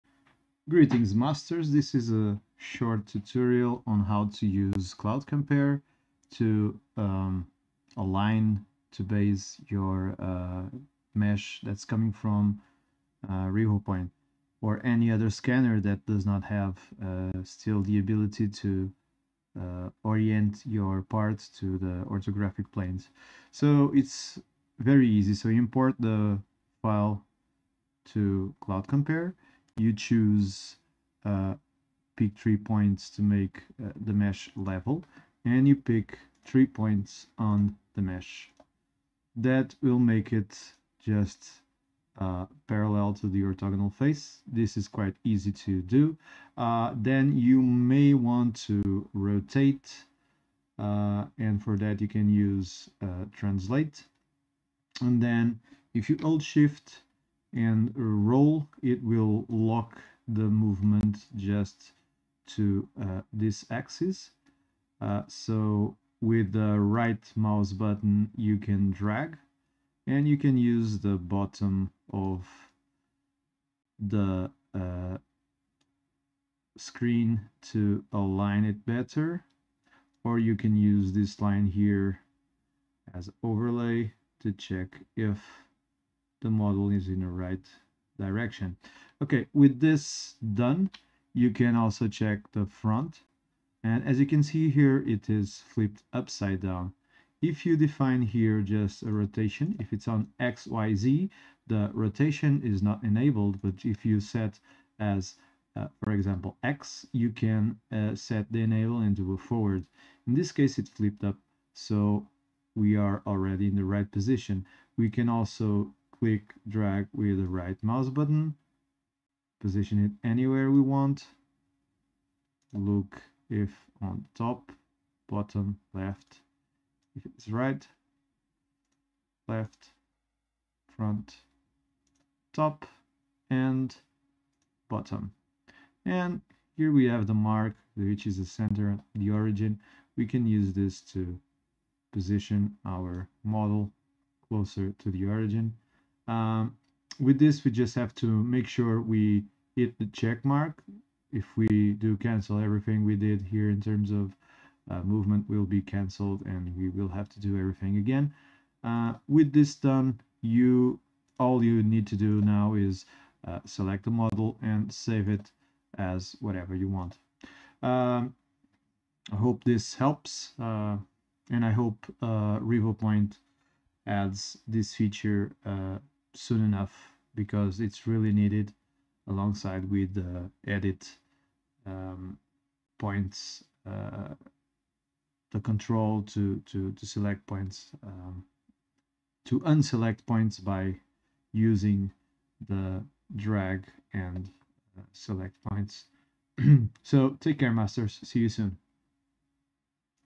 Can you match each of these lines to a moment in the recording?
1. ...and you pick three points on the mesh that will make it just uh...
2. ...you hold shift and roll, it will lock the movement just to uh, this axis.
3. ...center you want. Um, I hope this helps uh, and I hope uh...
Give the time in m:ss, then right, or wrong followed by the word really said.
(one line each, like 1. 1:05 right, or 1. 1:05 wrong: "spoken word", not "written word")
1. 0:35 right
2. 0:56 right
3. 2:46 wrong: "whatever", not "center".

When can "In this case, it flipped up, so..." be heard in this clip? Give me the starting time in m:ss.
1:50.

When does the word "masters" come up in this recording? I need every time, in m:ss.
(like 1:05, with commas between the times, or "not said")
0:01, 3:17.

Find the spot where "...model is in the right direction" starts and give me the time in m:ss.
1:26.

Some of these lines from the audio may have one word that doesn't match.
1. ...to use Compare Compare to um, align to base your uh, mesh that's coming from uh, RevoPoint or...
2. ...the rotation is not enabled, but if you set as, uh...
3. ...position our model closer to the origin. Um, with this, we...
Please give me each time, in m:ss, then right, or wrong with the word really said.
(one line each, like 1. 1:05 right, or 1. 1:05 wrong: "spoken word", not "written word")
1. 0:04 wrong: "Cloud", not "Compare"
2. 1:41 right
3. 2:22 right.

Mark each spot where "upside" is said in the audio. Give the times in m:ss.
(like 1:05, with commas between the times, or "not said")
1:36.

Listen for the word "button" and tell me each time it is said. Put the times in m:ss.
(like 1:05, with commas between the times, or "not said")
1:07, 1:58.